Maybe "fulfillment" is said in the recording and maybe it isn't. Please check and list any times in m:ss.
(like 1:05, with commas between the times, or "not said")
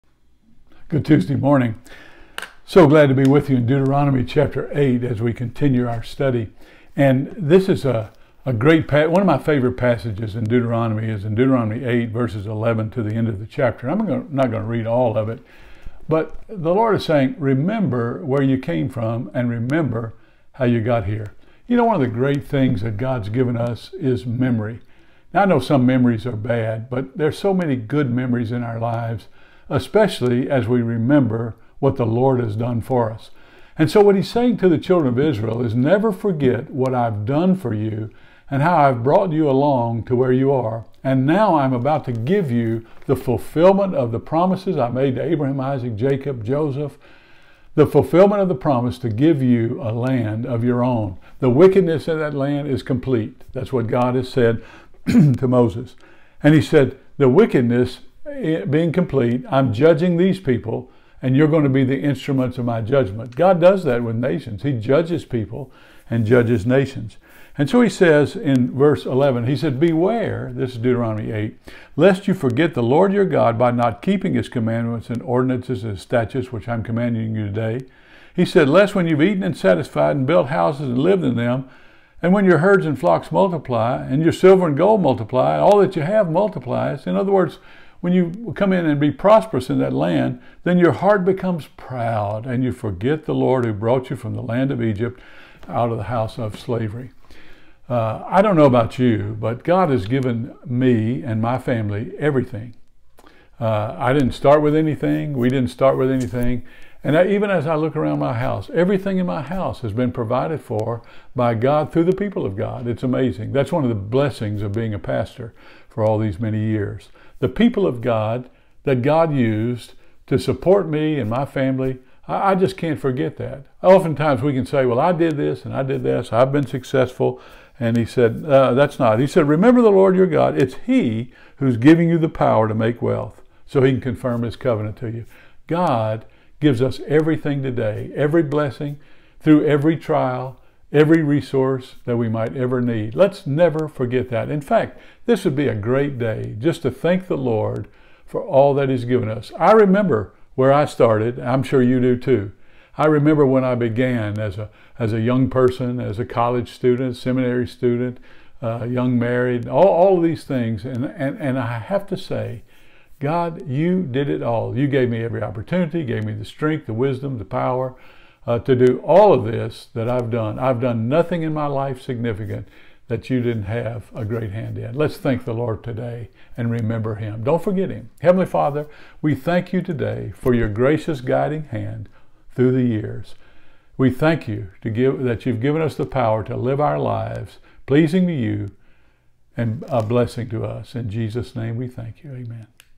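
0:43, 0:47.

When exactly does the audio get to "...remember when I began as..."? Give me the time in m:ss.
2:33.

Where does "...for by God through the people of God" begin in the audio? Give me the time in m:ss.
1:50.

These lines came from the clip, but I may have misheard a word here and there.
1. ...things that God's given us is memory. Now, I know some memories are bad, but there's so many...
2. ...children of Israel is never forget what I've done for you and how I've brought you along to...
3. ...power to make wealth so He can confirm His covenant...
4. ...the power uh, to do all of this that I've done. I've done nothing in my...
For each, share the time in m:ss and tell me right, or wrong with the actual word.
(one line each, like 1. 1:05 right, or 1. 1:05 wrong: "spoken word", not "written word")
1. 0:22 right
2. 0:34 right
3. 2:12 right
4. 2:47 right.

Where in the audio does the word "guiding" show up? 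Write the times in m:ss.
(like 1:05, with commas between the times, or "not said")
3:01.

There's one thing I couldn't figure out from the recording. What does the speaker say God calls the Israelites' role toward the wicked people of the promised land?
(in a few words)
instruments of my judgment.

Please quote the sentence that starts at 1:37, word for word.
Uh, I don't know about you, but God has given me and my family everything.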